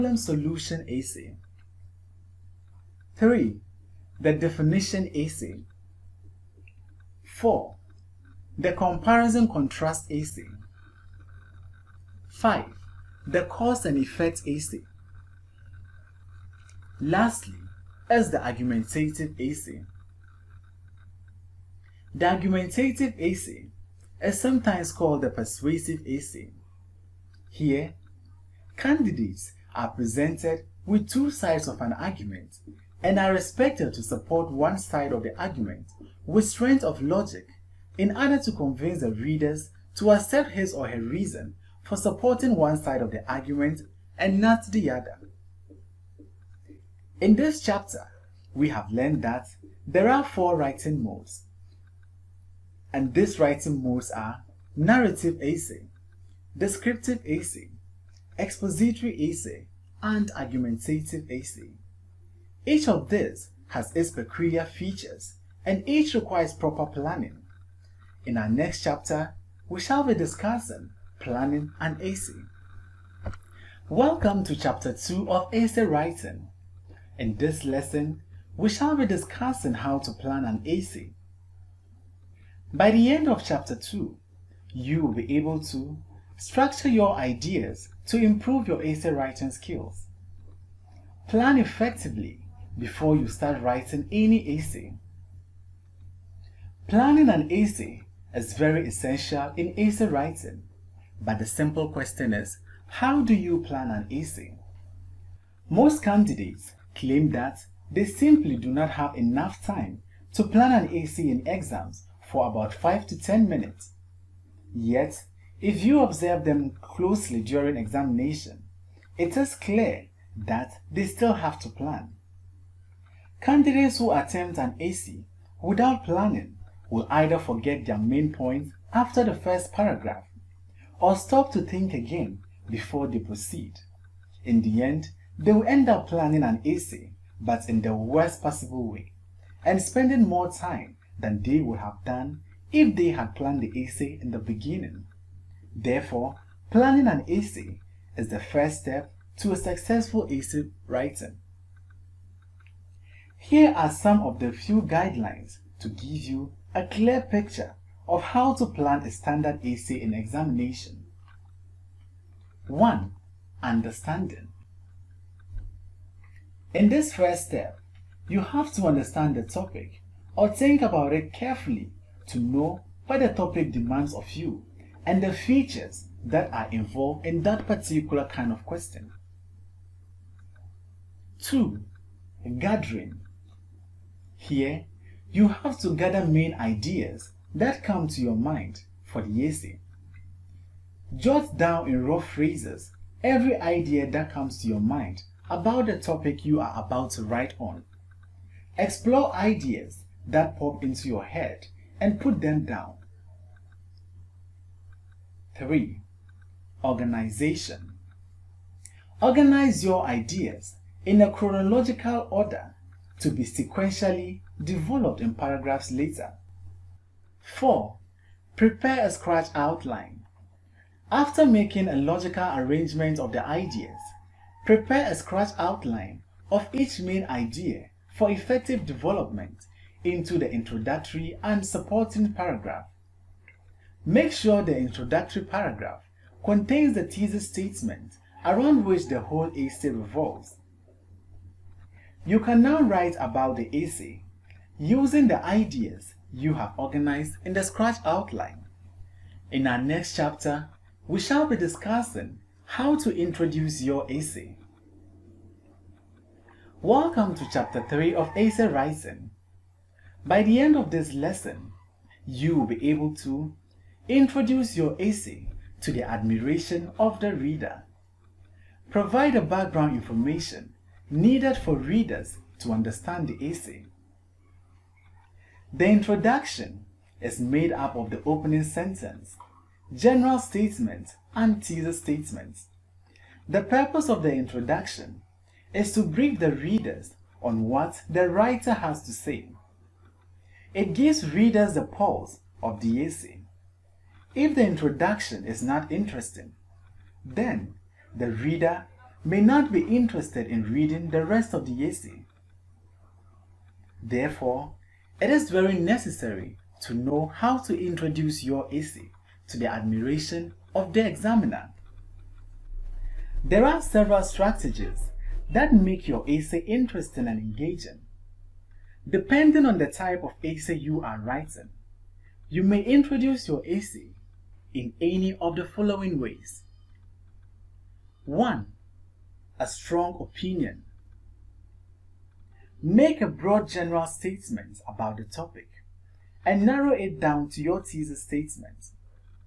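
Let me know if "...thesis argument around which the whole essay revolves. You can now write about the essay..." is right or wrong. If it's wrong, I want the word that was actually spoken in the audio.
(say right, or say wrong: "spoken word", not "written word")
wrong: "statement", not "argument".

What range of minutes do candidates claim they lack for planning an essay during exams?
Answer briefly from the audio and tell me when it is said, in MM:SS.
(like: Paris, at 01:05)
5 to 10, at 01:52.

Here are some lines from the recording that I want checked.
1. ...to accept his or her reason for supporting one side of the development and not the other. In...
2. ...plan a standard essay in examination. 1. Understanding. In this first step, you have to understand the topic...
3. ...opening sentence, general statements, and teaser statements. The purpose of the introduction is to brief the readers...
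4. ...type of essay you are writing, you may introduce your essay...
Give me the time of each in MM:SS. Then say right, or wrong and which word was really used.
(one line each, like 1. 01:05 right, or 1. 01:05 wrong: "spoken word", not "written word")
1. 00:39 wrong: "argument", not "development"
2. 02:38 right
3. 04:38 right
4. 05:19 right.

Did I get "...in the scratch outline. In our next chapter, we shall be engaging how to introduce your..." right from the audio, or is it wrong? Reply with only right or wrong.
wrong.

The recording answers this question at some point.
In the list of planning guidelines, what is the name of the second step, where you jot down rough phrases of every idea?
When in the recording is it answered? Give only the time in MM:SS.
03:02.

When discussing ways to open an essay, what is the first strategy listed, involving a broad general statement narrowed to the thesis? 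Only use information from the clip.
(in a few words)
A strong opinion.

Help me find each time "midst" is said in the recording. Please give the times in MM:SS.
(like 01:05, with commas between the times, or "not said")
not said.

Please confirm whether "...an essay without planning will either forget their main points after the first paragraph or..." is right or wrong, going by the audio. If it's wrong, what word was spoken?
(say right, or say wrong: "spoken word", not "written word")
right.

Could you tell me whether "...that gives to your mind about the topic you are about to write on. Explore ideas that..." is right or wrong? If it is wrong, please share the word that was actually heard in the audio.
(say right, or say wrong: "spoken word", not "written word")
wrong: "comes", not "gives".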